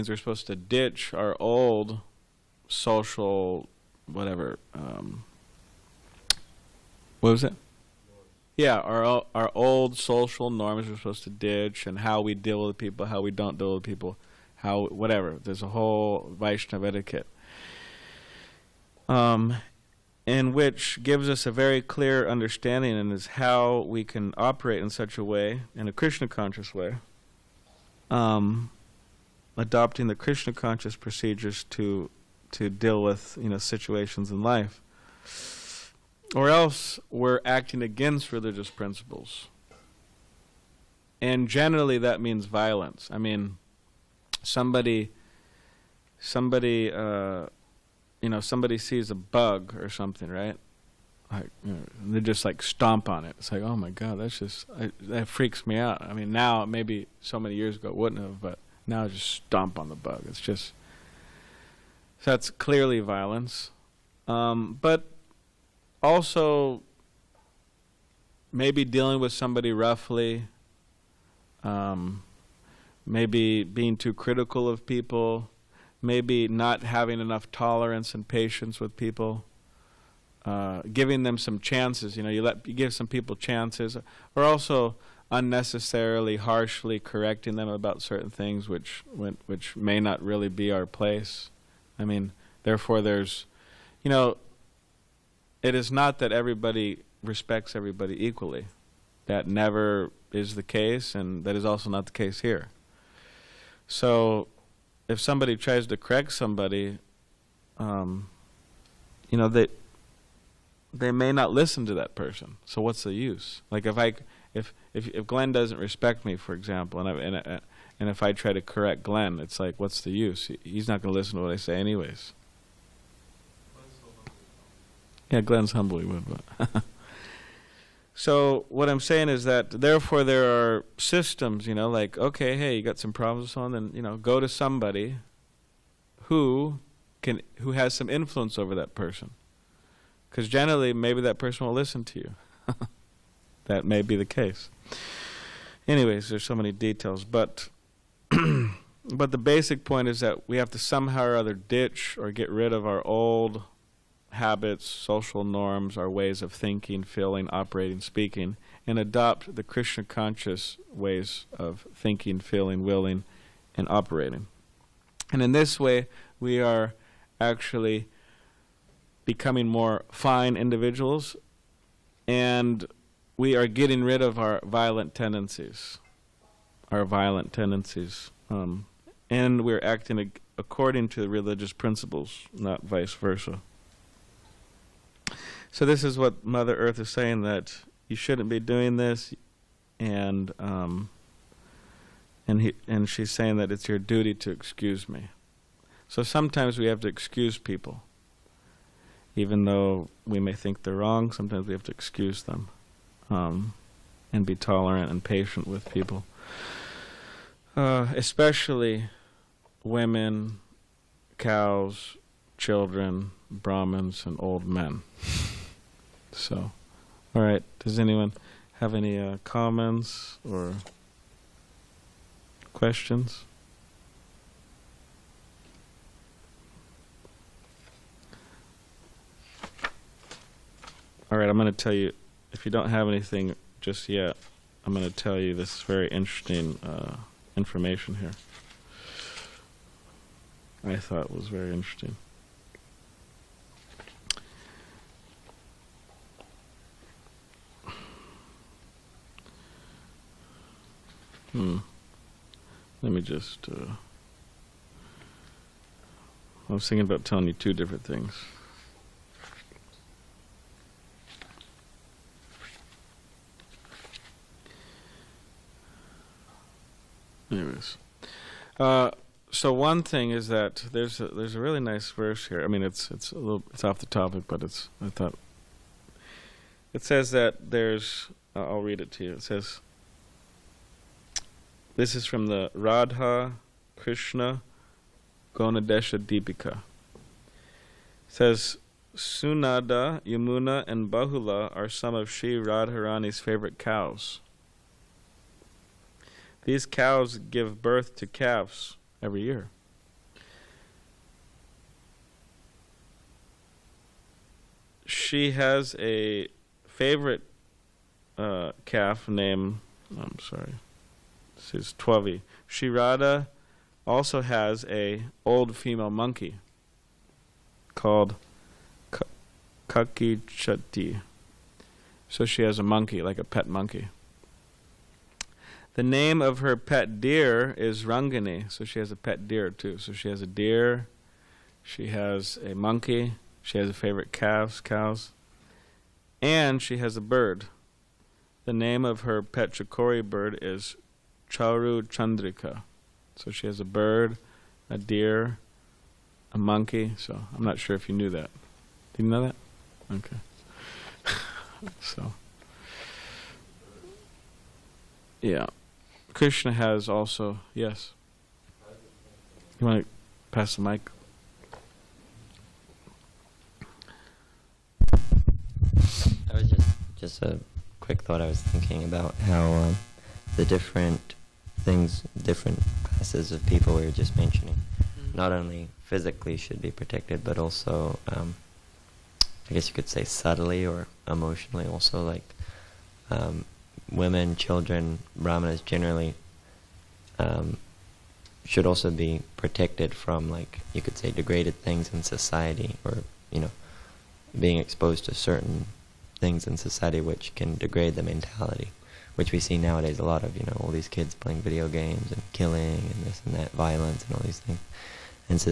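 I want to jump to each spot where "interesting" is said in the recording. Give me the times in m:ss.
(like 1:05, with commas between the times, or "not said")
3:56, 4:01.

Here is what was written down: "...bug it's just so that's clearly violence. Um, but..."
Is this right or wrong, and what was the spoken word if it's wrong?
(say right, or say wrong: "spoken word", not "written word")
right.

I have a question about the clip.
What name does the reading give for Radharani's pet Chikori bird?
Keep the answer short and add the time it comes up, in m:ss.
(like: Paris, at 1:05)
Charu Chandrika, at 5:41.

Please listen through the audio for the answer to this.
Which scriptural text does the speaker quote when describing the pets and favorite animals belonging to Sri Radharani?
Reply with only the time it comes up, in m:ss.
4:42.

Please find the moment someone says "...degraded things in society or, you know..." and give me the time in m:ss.
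6:31.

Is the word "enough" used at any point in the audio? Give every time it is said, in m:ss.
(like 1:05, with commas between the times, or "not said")
1:17.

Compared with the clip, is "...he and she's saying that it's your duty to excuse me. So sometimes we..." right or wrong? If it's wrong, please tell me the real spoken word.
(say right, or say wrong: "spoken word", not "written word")
right.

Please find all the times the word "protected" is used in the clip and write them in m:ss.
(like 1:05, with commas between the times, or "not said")
6:16, 6:29.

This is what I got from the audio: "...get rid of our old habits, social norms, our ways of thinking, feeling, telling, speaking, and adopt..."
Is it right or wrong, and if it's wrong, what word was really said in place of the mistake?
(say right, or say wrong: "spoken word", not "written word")
wrong: "operating", not "telling".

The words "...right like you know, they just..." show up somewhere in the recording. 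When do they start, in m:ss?
0:50.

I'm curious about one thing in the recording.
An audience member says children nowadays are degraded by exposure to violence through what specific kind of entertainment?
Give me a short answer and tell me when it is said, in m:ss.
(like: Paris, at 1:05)
video games, at 6:41.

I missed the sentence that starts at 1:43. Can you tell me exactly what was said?
So, if somebody tries to correct somebody, um, you know, they they may not listen to that person.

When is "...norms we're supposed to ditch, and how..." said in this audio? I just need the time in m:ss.
0:10.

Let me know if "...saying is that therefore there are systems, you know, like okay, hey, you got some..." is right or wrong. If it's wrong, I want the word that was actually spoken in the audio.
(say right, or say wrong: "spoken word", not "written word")
right.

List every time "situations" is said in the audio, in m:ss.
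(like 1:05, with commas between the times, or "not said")
0:33.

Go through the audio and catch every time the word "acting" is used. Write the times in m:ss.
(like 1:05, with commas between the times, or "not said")
0:37, 2:59.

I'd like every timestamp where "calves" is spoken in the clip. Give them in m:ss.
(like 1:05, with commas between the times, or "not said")
4:58, 5:34.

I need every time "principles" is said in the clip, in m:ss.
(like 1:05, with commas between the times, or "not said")
0:38, 3:01.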